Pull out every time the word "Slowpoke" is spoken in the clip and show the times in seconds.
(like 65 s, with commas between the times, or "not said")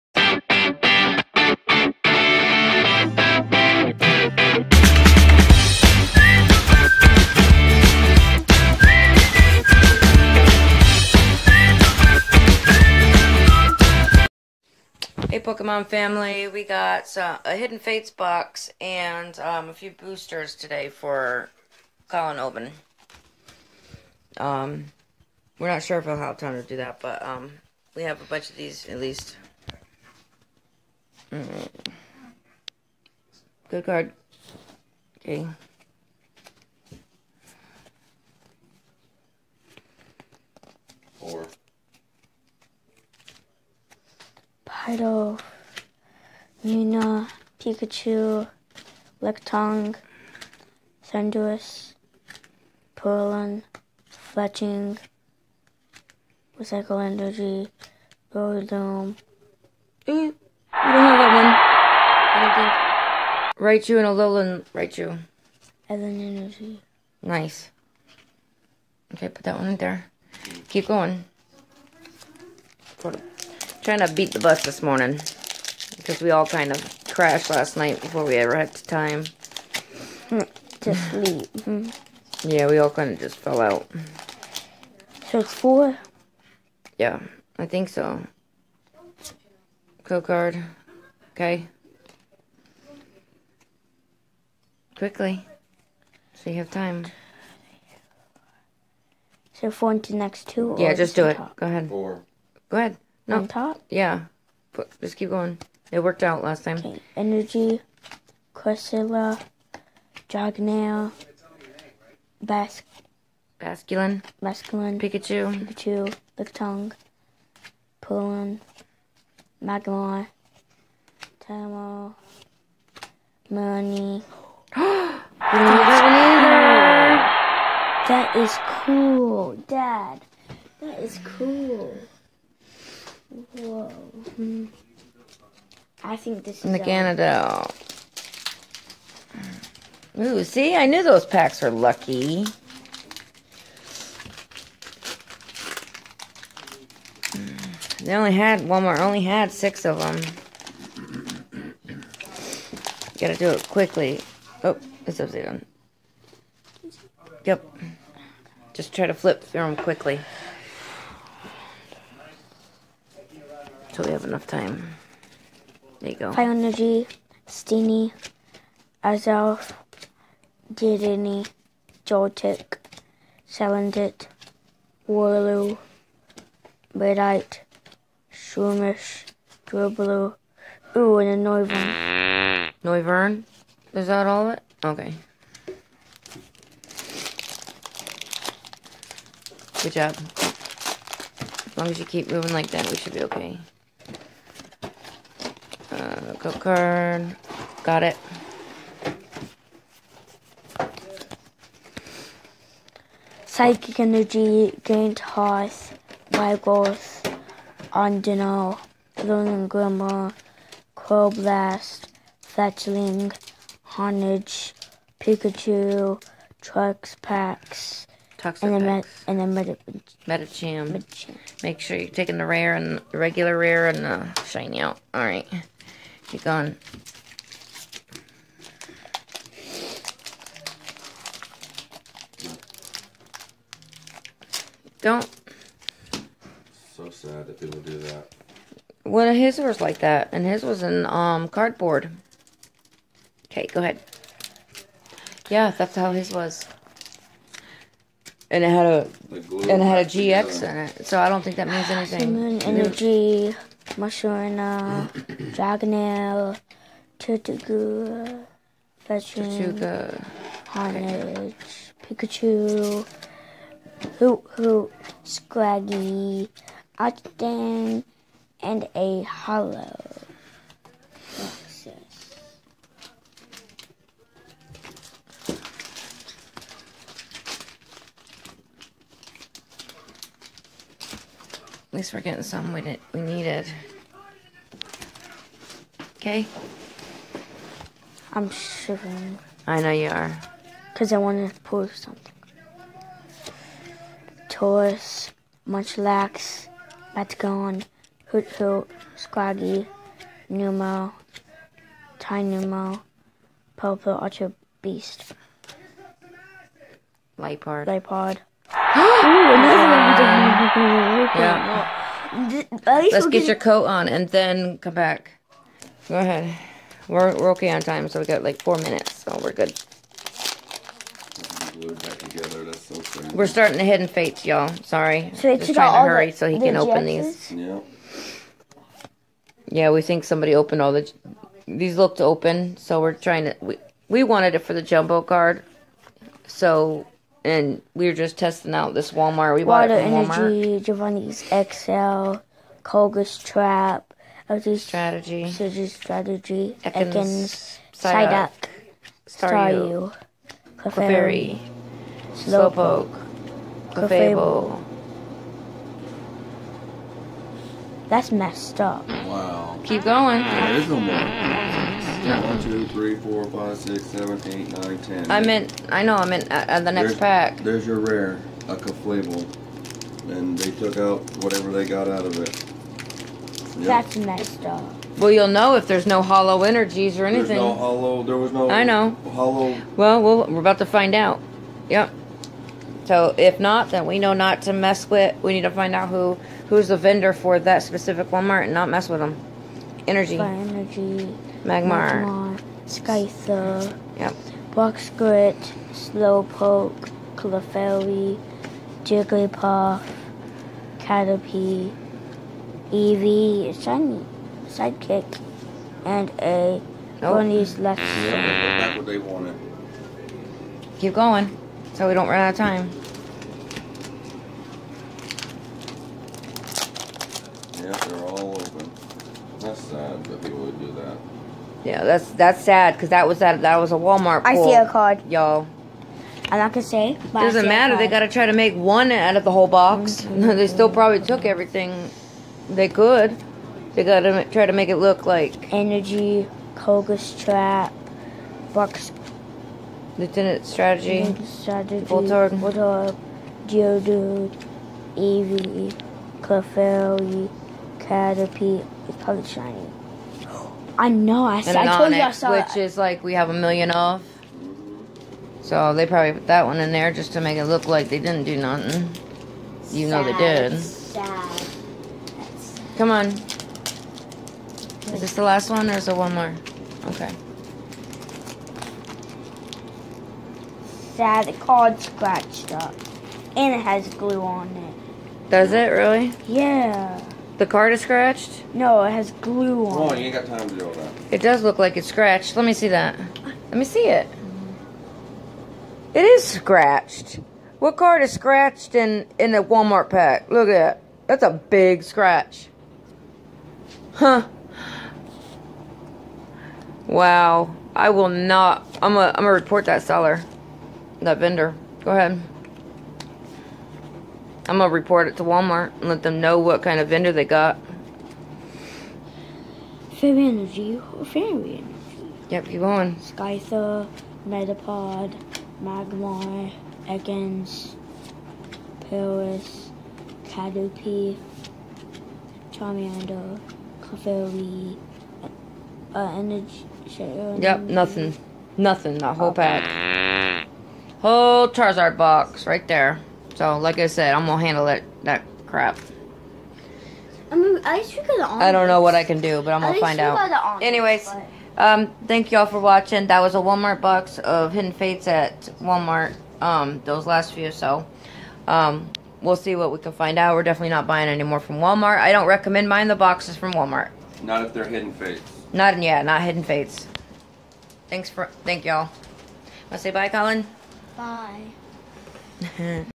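352 s, 395 s.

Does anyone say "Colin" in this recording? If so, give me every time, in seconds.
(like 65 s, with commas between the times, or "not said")
22 s, 560 s.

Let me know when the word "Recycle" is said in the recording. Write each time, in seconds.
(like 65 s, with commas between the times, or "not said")
56 s.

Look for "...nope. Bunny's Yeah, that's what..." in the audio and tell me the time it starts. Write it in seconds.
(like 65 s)
407 s.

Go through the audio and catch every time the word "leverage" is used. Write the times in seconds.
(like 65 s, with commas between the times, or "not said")
not said.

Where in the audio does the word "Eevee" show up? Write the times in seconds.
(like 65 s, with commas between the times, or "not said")
402 s, 445 s.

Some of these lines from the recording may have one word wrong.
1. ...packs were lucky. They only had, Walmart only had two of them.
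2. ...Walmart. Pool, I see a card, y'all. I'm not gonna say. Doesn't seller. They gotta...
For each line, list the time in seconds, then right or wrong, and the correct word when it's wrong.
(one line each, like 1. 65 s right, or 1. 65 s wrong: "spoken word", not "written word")
1. 141 s wrong: "six", not "two"
2. 423 s wrong: "matter", not "seller".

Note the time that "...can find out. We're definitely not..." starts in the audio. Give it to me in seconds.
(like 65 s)
549 s.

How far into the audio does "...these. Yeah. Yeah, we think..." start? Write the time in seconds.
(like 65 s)
327 s.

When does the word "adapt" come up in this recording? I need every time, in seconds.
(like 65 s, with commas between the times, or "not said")
not said.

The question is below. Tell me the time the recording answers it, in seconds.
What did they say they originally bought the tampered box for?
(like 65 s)
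334 s.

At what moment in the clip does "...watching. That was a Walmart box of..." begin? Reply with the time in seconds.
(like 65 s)
542 s.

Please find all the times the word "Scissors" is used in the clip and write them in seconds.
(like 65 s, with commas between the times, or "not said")
345 s.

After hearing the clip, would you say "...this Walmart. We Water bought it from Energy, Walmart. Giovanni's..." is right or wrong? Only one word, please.
right.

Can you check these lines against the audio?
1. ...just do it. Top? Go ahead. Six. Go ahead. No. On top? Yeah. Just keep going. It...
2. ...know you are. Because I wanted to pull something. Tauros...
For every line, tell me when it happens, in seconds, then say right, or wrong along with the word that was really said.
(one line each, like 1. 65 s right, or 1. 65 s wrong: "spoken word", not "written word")
1. 100 s wrong: "Four", not "Six"
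2. 289 s right.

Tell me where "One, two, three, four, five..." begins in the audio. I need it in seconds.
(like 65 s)
362 s.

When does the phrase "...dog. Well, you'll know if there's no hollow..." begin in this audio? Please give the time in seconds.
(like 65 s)
374 s.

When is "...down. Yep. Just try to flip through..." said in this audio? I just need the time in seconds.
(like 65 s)
155 s.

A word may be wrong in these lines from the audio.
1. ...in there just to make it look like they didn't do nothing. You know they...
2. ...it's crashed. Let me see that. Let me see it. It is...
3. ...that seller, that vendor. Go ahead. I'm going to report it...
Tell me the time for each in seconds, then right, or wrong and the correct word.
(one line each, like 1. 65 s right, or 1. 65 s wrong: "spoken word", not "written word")
1. 456 s right
2. 481 s wrong: "scratched", not "crashed"
3. 499 s right.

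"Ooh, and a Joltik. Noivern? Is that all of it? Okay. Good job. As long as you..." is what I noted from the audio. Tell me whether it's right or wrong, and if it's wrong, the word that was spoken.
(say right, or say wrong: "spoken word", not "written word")
wrong: "Noivern", not "Joltik".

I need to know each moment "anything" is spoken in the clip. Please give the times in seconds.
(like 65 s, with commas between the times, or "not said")
251 s, 377 s.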